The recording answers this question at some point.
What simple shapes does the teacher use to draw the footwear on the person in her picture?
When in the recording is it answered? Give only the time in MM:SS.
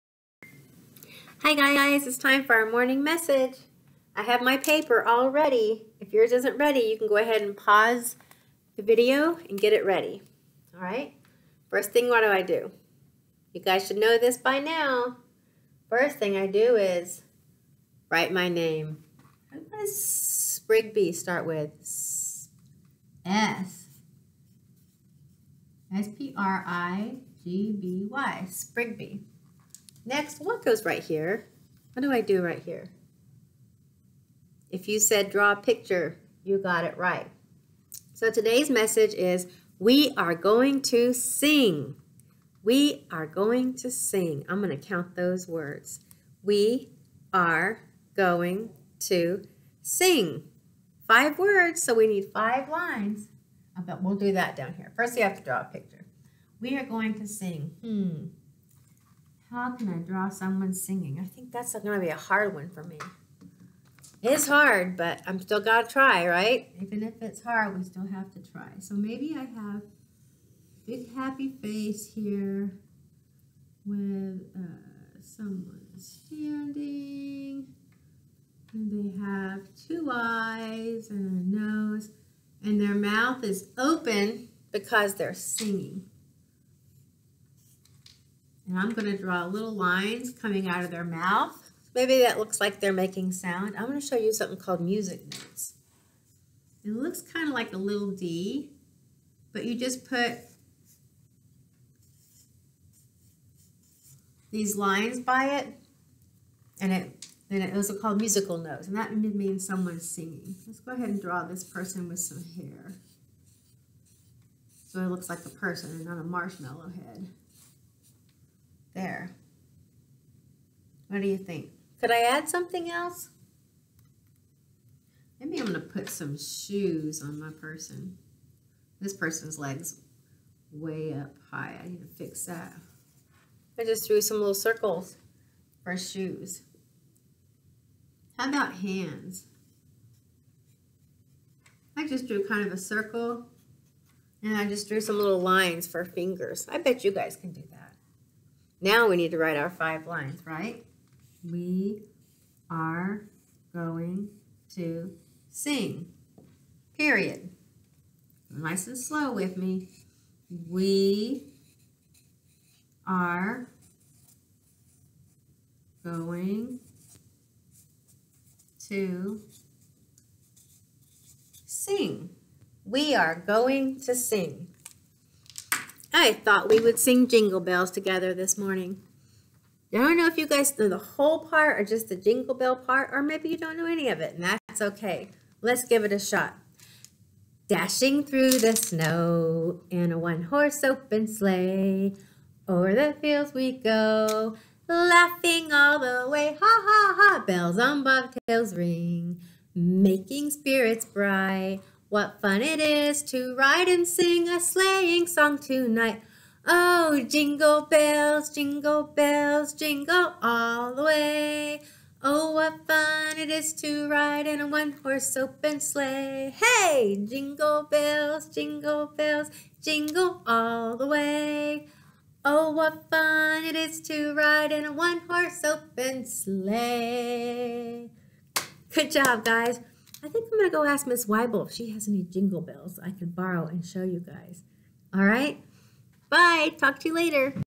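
02:14.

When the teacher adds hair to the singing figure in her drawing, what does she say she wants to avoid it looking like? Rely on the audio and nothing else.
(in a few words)
a marshmallow head.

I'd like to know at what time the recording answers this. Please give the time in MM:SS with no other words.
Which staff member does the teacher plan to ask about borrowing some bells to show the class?
03:51.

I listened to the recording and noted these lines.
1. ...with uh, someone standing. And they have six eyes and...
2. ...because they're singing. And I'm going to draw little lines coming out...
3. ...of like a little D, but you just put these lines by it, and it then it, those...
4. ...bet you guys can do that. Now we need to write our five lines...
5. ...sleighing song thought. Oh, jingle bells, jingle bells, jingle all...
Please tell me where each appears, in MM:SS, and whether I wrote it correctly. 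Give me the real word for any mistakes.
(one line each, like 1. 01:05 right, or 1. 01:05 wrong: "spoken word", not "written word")
1. 01:13 wrong: "two", not "six"
2. 01:24 right
3. 01:37 right
4. 02:26 right
5. 03:24 wrong: "tonight", not "thought".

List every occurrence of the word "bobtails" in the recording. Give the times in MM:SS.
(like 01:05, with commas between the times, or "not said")
03:18.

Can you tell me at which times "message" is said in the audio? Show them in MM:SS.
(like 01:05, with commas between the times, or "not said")
00:03, 00:38.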